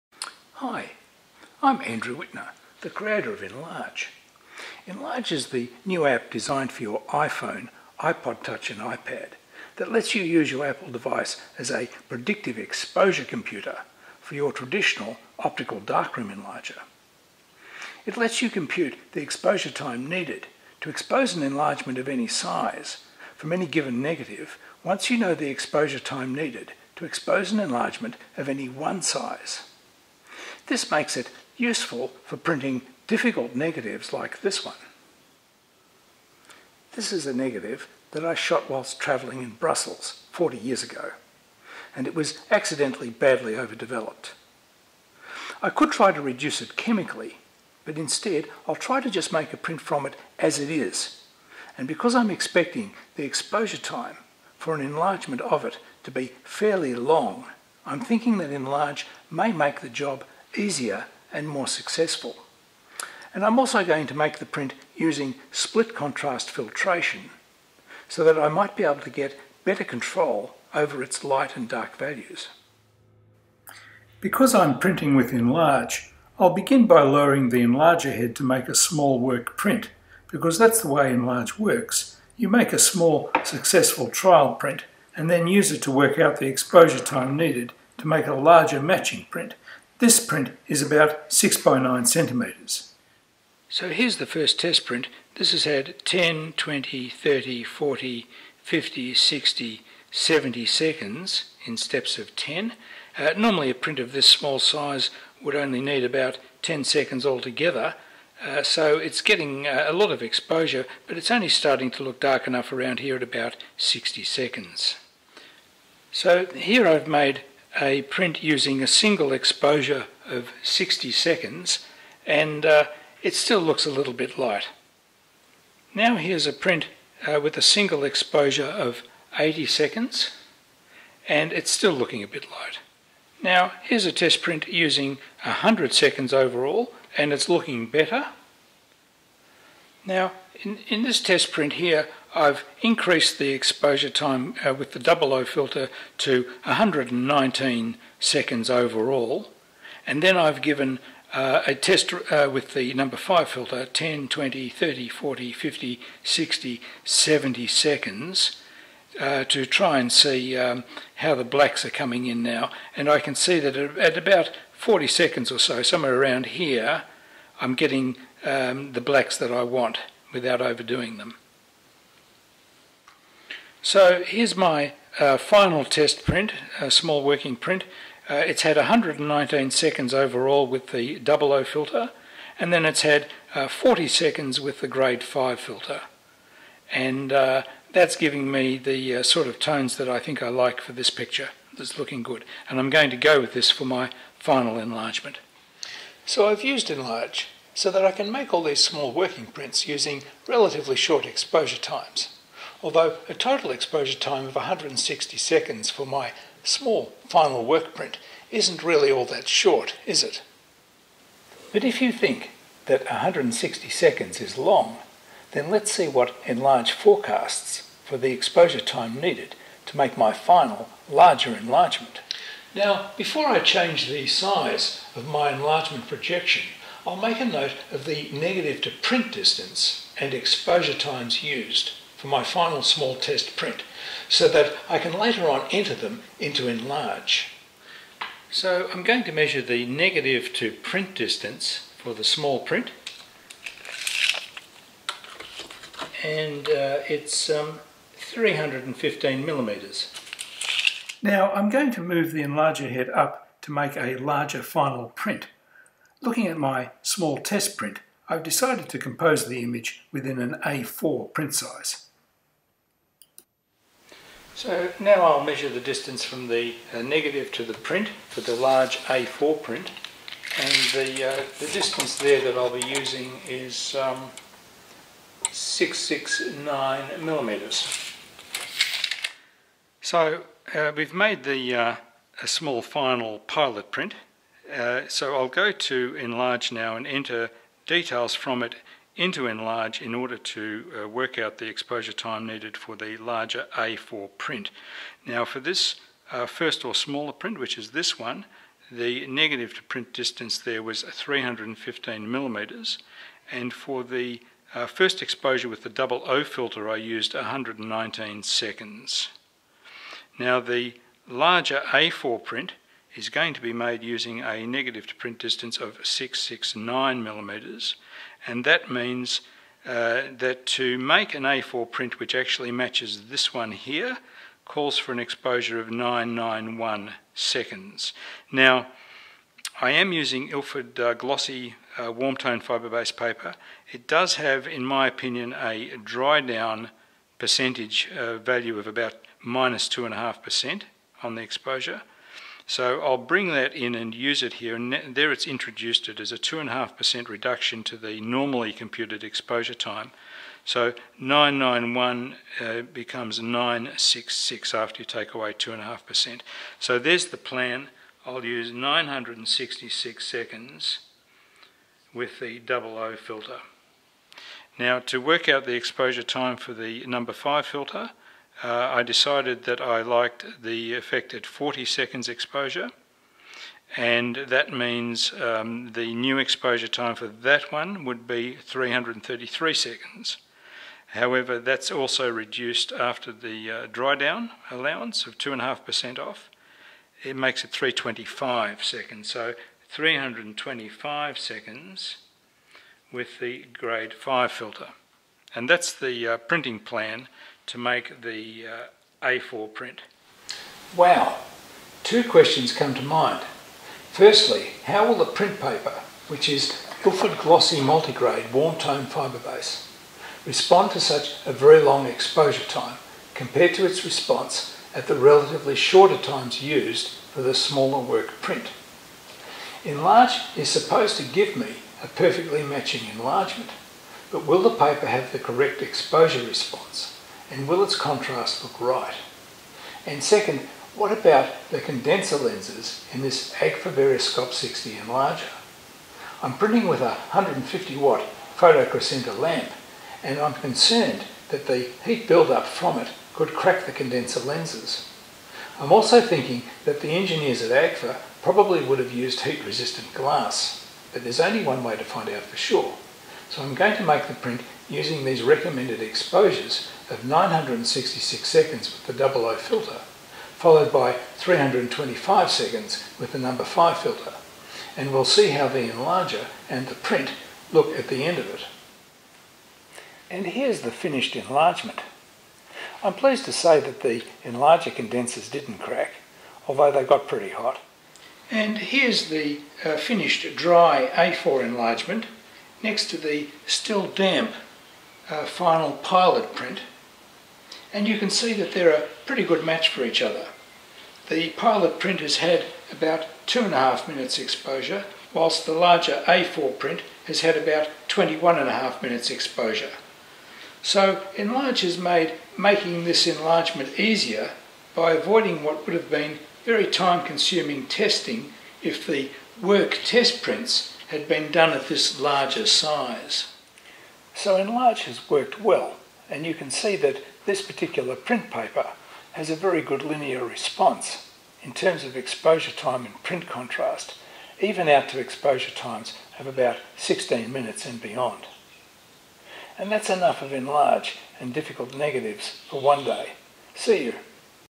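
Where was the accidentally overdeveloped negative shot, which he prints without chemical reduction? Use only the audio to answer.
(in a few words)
Brussels.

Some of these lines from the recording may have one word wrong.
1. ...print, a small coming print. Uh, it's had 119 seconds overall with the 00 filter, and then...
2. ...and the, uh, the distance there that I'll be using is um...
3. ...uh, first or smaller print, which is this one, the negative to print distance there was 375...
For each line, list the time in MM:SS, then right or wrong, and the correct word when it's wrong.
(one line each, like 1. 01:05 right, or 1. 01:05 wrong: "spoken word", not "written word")
1. 02:56 wrong: "working", not "coming"
2. 04:30 right
3. 04:56 wrong: "315", not "375".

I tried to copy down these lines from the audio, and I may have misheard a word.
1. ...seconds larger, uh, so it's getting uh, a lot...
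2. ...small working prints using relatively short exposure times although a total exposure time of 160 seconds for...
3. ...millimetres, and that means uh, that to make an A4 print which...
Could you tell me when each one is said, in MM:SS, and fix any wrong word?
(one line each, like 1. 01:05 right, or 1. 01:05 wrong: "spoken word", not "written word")
1. 01:46 wrong: "altogether", not "larger"
2. 03:18 right
3. 05:17 right.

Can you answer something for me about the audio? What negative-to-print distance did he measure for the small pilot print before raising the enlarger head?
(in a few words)
315 millimetres.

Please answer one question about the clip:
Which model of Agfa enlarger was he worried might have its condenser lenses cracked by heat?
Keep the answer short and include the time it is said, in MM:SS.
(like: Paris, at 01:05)
Agfa Scope 60, at 07:13.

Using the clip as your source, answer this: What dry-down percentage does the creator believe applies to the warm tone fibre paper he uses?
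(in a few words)
minus 2.5%.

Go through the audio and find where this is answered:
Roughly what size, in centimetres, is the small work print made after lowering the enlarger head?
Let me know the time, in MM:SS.
01:31.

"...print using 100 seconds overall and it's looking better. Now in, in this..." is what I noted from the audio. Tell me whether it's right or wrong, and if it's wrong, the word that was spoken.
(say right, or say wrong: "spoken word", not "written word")
right.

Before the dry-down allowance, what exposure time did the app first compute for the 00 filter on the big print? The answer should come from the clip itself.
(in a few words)
991 seconds.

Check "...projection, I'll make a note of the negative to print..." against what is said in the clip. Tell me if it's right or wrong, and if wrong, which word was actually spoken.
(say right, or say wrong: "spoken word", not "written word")
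right.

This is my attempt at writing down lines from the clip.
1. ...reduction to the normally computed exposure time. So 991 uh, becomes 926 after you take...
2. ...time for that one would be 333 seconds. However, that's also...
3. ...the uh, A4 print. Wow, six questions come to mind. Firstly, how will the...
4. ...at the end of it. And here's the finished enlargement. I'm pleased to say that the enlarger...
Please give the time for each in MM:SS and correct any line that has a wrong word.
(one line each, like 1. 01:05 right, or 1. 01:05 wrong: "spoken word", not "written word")
1. 05:47 wrong: "966", not "926"
2. 06:16 right
3. 06:38 wrong: "two", not "six"
4. 07:47 right.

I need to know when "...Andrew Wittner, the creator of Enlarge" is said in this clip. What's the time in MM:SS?
00:01.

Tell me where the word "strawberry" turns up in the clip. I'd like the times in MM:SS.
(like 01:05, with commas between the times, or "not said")
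not said.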